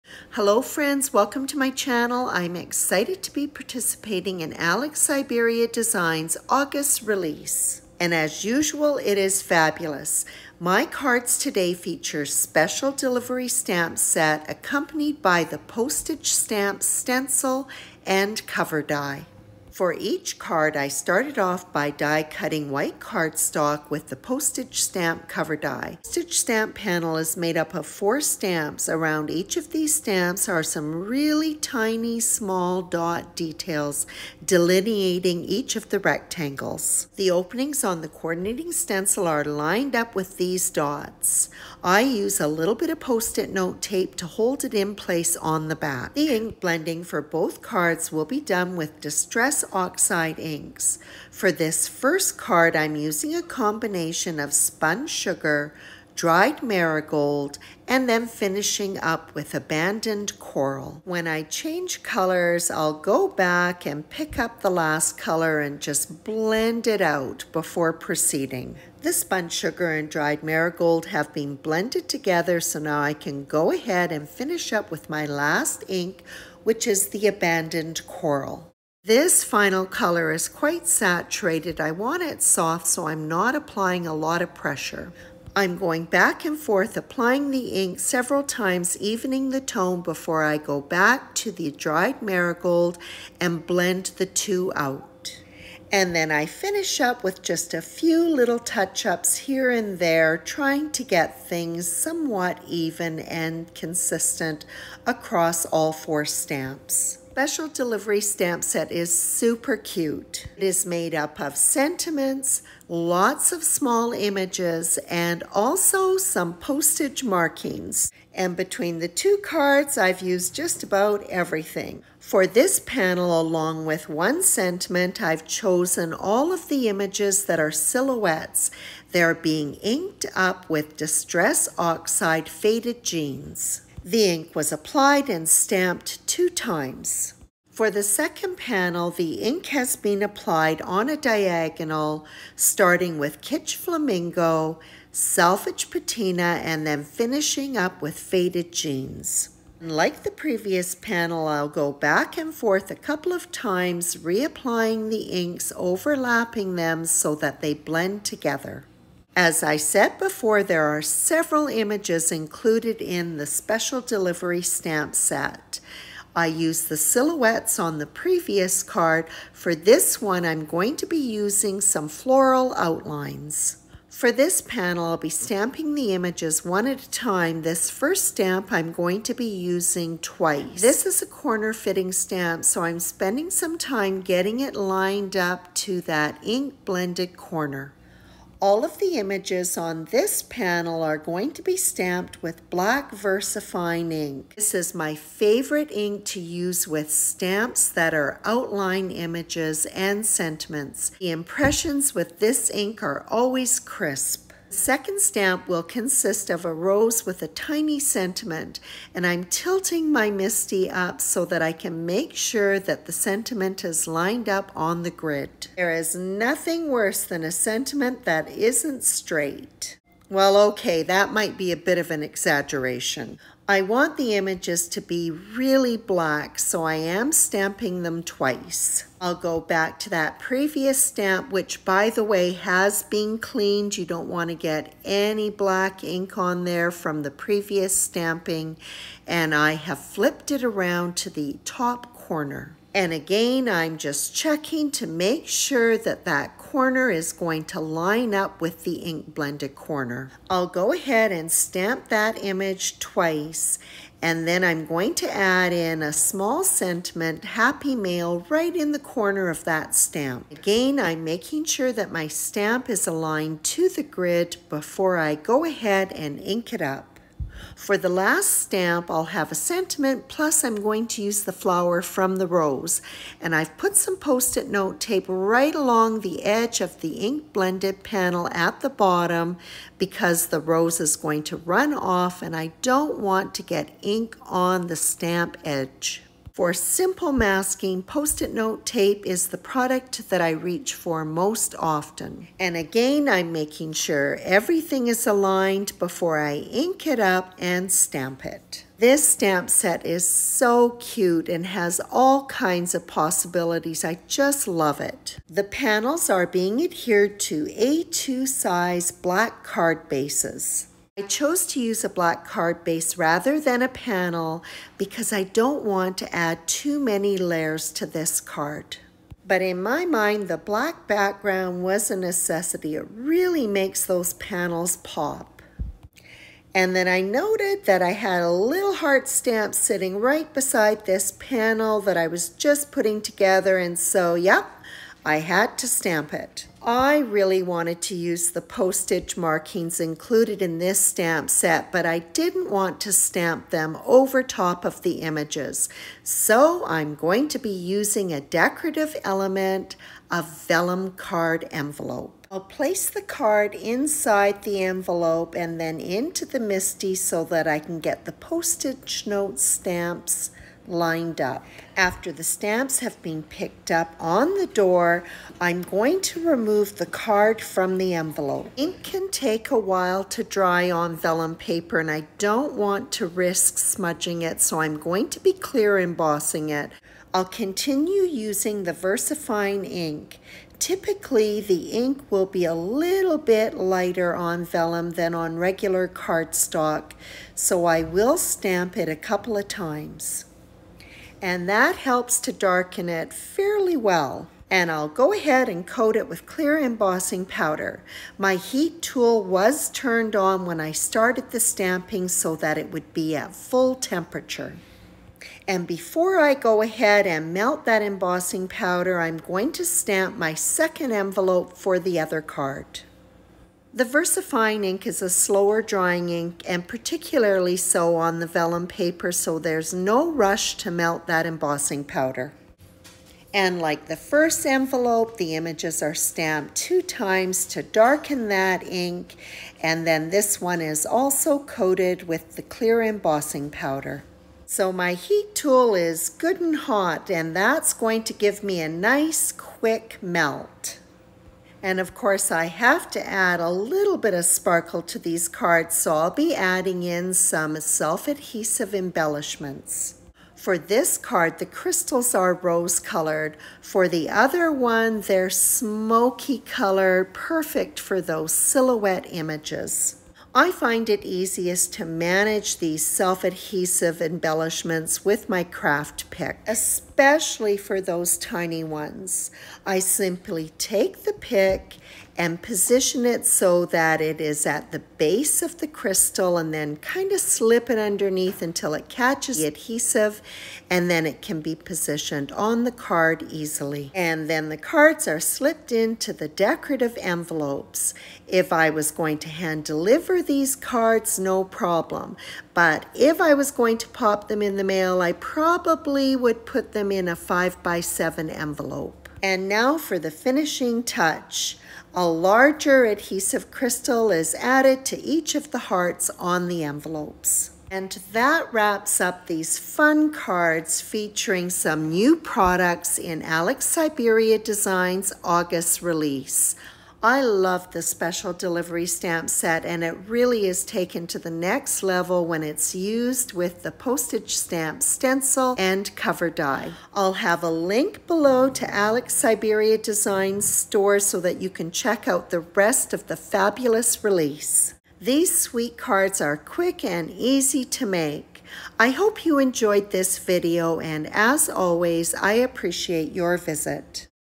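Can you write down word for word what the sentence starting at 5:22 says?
It really makes those panels pop.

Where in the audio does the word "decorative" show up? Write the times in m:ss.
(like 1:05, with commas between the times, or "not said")
5:48, 8:06.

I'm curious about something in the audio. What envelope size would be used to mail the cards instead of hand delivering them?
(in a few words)
5 by 7.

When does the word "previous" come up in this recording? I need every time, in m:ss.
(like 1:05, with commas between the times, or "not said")
2:30, 2:48, 3:50, 3:57.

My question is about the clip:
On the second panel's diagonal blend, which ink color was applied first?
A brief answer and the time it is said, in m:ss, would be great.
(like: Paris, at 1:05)
Kitsch Flamingo, at 2:23.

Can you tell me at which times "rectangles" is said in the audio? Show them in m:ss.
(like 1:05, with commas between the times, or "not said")
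0:35.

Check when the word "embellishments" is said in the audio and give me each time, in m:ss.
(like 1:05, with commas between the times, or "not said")
7:28, 7:44.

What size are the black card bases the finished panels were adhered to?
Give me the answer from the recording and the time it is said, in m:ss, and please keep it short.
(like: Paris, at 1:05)
A2, at 5:07.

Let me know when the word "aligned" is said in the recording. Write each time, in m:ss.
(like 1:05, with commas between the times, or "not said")
4:23, 4:55.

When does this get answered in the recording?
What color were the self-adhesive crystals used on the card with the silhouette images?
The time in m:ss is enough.
7:35.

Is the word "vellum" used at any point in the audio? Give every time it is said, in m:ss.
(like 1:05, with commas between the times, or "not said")
5:50, 6:11, 6:24, 6:58.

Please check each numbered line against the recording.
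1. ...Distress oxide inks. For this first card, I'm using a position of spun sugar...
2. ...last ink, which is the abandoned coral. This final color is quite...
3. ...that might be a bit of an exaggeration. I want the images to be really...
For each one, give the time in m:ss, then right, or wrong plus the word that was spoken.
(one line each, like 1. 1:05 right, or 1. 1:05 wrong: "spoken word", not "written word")
1. 0:48 wrong: "combination", not "position"
2. 1:15 right
3. 3:41 right.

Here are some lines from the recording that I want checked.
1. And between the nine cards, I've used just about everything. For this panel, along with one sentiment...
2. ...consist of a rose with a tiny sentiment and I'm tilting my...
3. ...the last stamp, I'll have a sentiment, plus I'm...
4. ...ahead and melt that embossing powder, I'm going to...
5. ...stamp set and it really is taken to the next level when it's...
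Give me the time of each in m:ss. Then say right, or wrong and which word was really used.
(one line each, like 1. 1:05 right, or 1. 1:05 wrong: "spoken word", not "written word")
1. 1:58 wrong: "two", not "nine"
2. 3:25 right
3. 4:27 right
4. 6:46 right
5. 8:39 right.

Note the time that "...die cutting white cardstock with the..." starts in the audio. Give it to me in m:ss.
0:21.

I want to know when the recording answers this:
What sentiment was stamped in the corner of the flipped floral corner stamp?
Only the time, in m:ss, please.
4:17.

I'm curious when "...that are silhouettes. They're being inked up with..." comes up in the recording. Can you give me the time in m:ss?
2:07.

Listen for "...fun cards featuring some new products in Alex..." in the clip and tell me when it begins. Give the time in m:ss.
8:29.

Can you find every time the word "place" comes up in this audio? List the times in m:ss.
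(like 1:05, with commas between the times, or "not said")
0:44, 5:52.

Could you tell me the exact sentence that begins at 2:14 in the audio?
The ink was applied and stamped two times.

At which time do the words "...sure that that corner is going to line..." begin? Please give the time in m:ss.
4:05.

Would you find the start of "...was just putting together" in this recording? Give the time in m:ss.
5:32.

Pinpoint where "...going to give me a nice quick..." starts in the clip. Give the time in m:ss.
7:17.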